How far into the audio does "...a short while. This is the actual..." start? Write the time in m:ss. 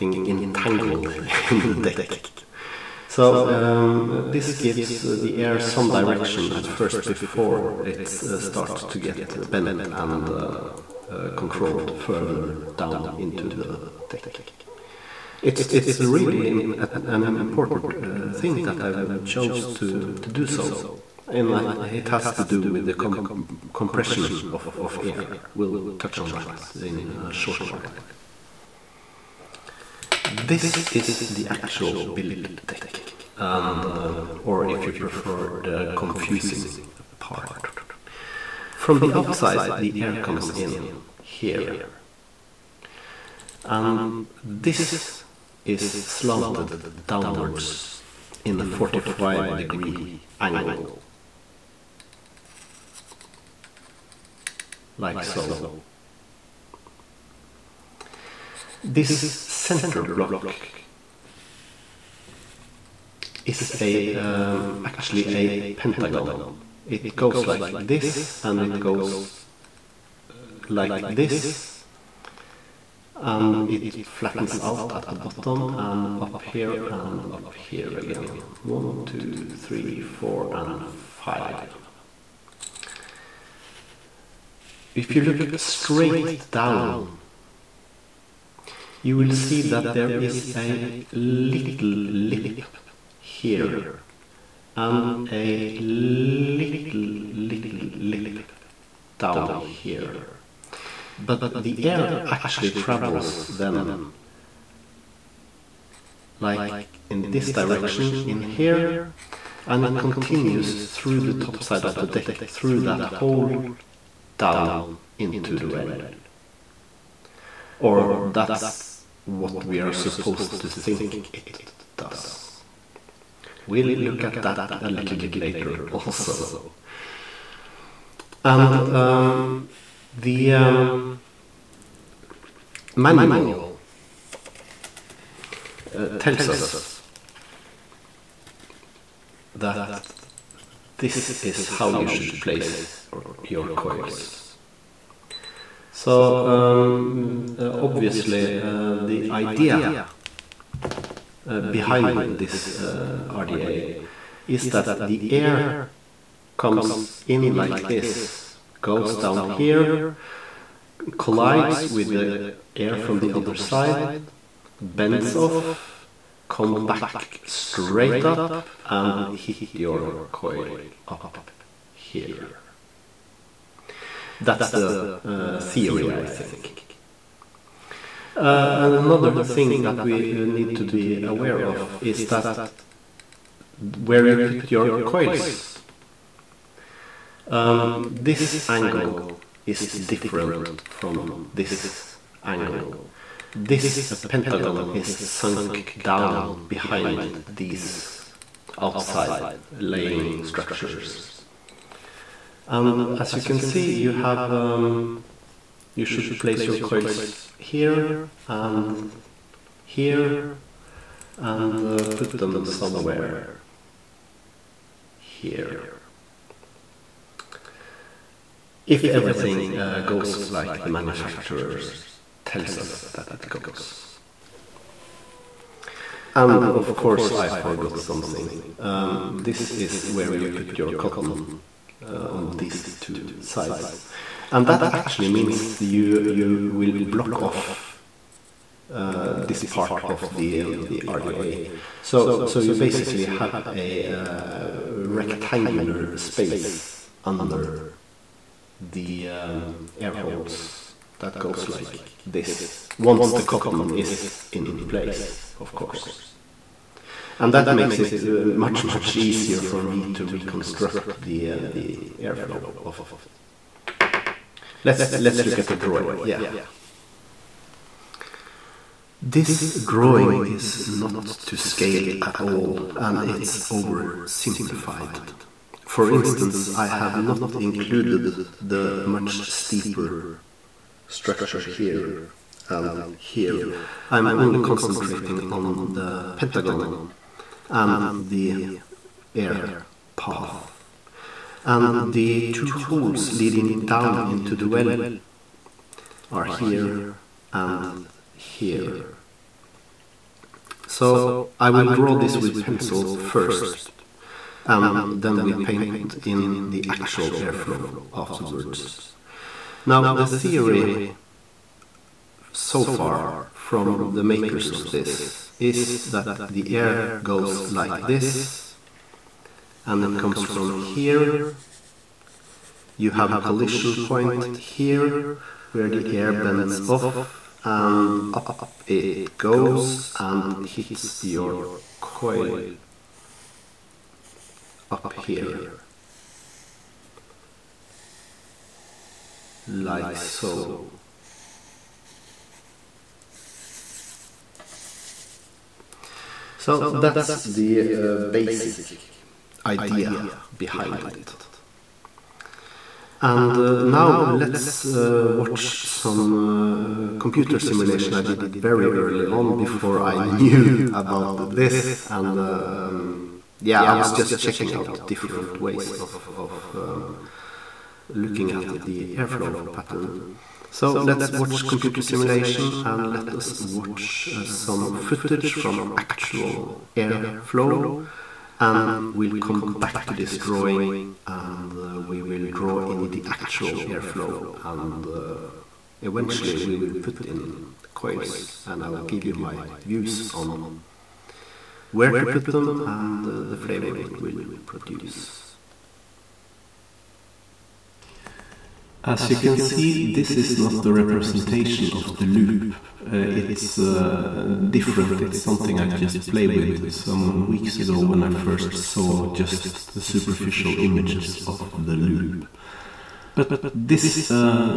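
0:27.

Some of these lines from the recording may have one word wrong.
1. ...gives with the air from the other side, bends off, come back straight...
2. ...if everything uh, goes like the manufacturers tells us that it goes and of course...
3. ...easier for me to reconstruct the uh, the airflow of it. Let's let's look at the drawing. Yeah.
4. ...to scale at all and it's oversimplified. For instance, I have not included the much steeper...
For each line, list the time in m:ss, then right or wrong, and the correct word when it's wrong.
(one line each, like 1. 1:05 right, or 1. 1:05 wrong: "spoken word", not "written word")
1. 2:41 wrong: "collides", not "gives"
2. 3:38 right
3. 4:19 right
4. 4:31 right.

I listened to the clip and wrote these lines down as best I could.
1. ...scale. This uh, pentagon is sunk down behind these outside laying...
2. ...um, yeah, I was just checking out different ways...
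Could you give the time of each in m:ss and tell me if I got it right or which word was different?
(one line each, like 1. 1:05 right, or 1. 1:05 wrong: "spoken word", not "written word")
1. 3:12 wrong: "angle", not "scale"
2. 6:02 right.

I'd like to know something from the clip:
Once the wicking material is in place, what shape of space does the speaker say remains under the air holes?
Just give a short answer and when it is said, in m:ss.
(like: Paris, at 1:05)
Rectangular, at 4:04.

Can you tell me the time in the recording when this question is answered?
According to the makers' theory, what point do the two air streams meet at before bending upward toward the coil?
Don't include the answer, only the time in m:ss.
5:23.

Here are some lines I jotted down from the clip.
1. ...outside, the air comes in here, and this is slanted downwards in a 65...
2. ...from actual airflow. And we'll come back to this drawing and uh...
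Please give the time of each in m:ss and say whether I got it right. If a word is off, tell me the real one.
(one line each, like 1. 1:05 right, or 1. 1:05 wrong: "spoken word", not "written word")
1. 0:39 wrong: "45", not "65"
2. 6:15 right.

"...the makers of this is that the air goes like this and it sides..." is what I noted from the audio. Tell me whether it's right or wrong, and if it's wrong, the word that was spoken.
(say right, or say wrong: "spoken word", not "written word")
wrong: "comes", not "sides".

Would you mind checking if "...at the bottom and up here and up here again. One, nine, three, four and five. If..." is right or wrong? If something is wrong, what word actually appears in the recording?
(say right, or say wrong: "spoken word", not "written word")
wrong: "two", not "nine".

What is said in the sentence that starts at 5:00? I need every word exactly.
So I will draw this with pencil first and then we paint in the actual airflow afterwards.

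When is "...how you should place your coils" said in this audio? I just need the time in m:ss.
2:21.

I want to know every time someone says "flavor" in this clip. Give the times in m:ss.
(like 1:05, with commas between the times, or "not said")
6:33.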